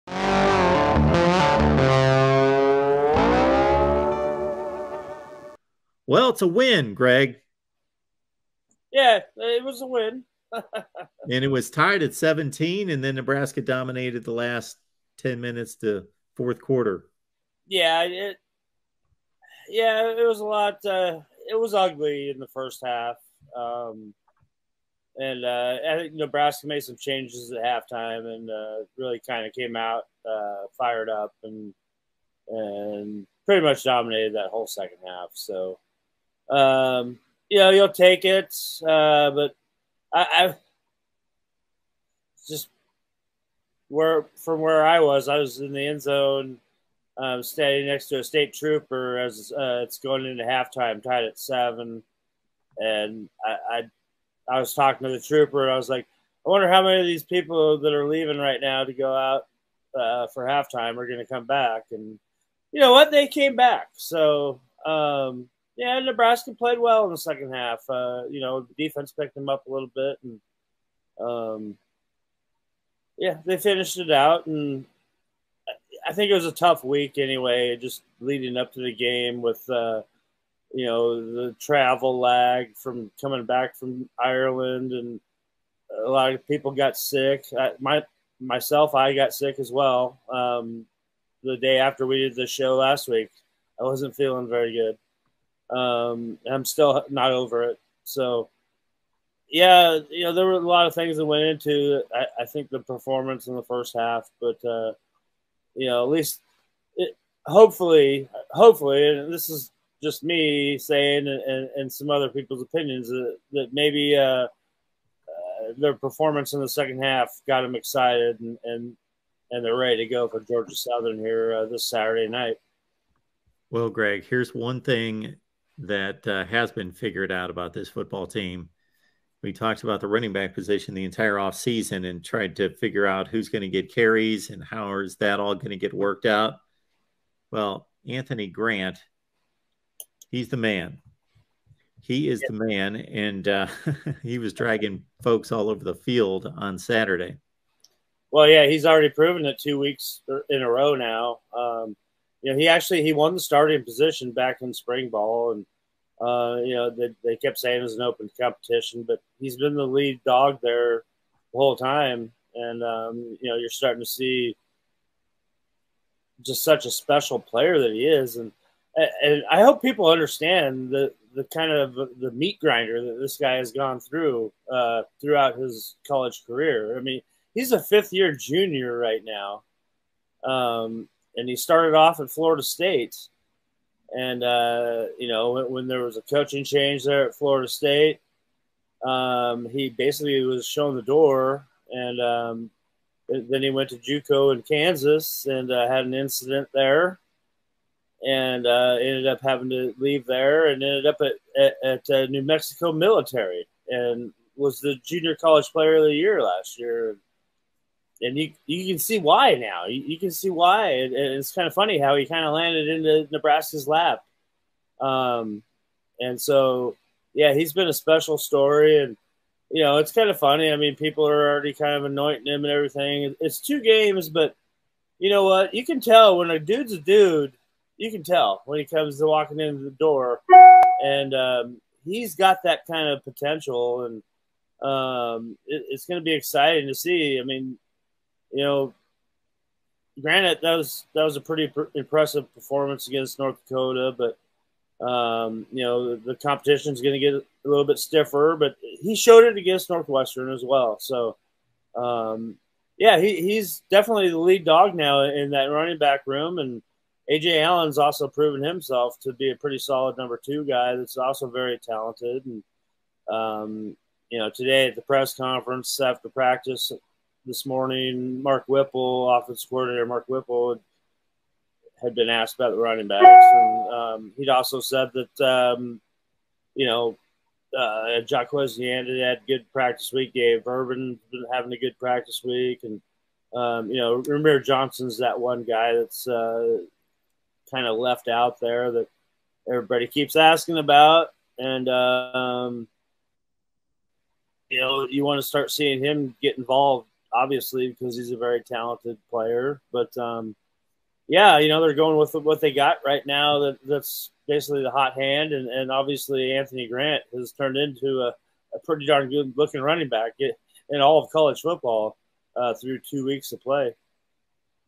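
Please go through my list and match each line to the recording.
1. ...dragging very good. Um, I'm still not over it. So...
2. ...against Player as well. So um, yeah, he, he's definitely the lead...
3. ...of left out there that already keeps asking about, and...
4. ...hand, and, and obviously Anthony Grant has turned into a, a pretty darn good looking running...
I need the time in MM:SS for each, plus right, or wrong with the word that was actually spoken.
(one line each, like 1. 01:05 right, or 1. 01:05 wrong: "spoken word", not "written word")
1. 01:34 wrong: "feeling", not "dragging"
2. 04:09 wrong: "Northwestern", not "Player"
3. 04:47 wrong: "everybody", not "already"
4. 05:05 right.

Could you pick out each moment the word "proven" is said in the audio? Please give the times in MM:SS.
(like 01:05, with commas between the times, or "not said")
02:29, 04:18.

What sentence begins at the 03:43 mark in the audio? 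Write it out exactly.
It's two games, but you know what?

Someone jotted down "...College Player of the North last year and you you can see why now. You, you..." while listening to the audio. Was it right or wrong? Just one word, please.
wrong.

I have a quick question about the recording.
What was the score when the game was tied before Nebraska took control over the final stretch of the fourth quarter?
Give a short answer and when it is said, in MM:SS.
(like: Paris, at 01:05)
17, at 00:11.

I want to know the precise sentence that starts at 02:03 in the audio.
Well, Greg, here's one thing that uh, has been figured out about this football team.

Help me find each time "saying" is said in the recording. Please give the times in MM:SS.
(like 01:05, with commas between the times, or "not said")
01:50, 02:37.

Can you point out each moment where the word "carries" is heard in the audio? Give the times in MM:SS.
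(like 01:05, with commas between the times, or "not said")
02:13.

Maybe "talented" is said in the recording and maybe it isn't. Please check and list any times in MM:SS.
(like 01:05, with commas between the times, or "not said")
04:21, 04:58.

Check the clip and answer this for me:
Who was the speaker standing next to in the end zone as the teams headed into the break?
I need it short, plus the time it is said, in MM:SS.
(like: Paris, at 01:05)
A state trooper, at 00:48.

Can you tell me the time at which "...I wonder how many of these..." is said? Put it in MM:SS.
00:56.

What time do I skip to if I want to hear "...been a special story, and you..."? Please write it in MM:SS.
03:37.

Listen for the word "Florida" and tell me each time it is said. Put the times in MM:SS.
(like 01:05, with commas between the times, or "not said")
03:02, 03:07.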